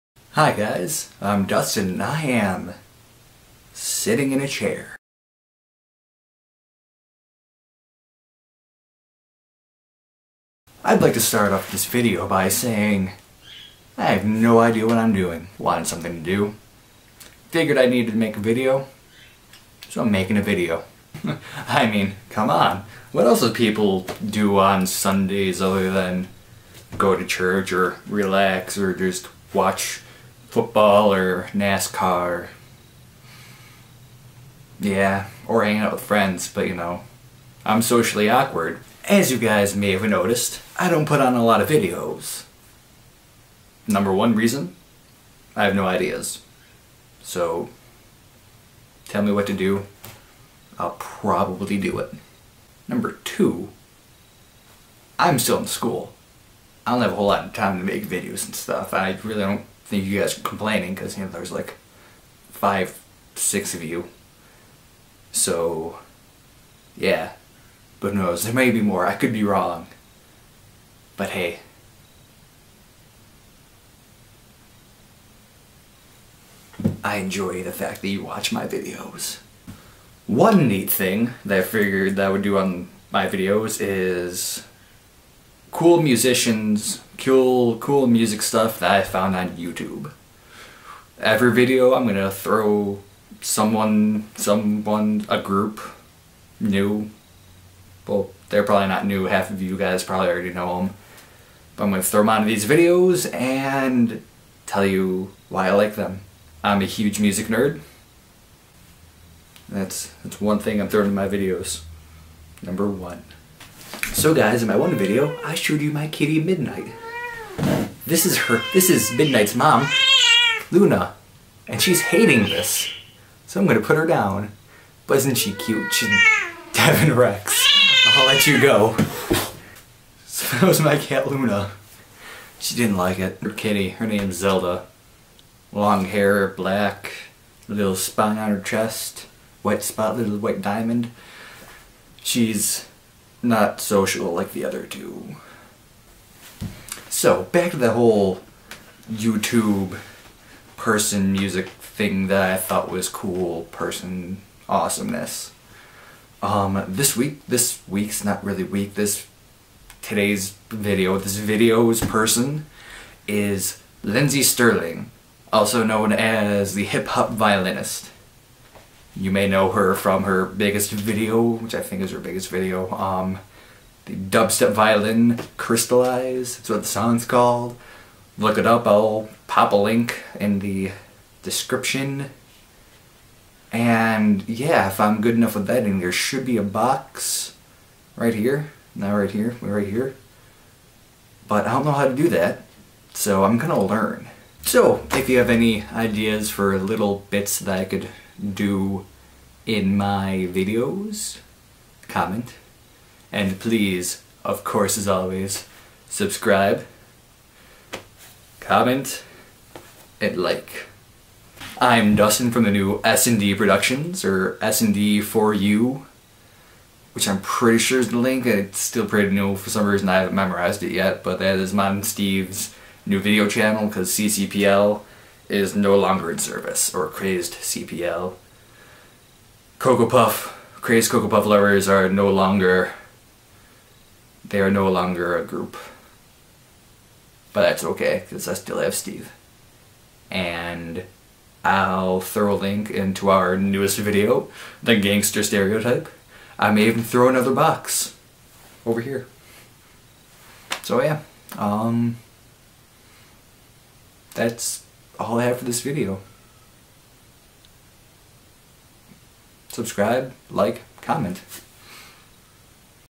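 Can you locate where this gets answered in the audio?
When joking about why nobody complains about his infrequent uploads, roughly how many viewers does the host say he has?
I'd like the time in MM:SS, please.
01:02.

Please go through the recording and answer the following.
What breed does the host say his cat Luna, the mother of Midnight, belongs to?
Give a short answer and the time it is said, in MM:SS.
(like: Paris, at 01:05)
Devon Rex, at 02:06.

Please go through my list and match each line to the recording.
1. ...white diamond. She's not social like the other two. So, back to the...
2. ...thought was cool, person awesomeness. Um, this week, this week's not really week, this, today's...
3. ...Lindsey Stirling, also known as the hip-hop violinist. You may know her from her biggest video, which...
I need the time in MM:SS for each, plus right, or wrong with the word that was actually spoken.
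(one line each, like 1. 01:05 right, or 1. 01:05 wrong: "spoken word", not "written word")
1. 02:20 right
2. 02:32 right
3. 02:44 right.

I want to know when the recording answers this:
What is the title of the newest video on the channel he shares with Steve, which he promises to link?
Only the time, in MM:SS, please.
04:04.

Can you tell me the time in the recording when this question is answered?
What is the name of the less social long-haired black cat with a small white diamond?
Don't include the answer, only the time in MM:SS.
02:14.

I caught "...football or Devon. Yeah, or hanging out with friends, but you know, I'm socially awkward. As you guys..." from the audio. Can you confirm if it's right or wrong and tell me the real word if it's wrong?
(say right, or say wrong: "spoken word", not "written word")
wrong: "NASCAR", not "Devon".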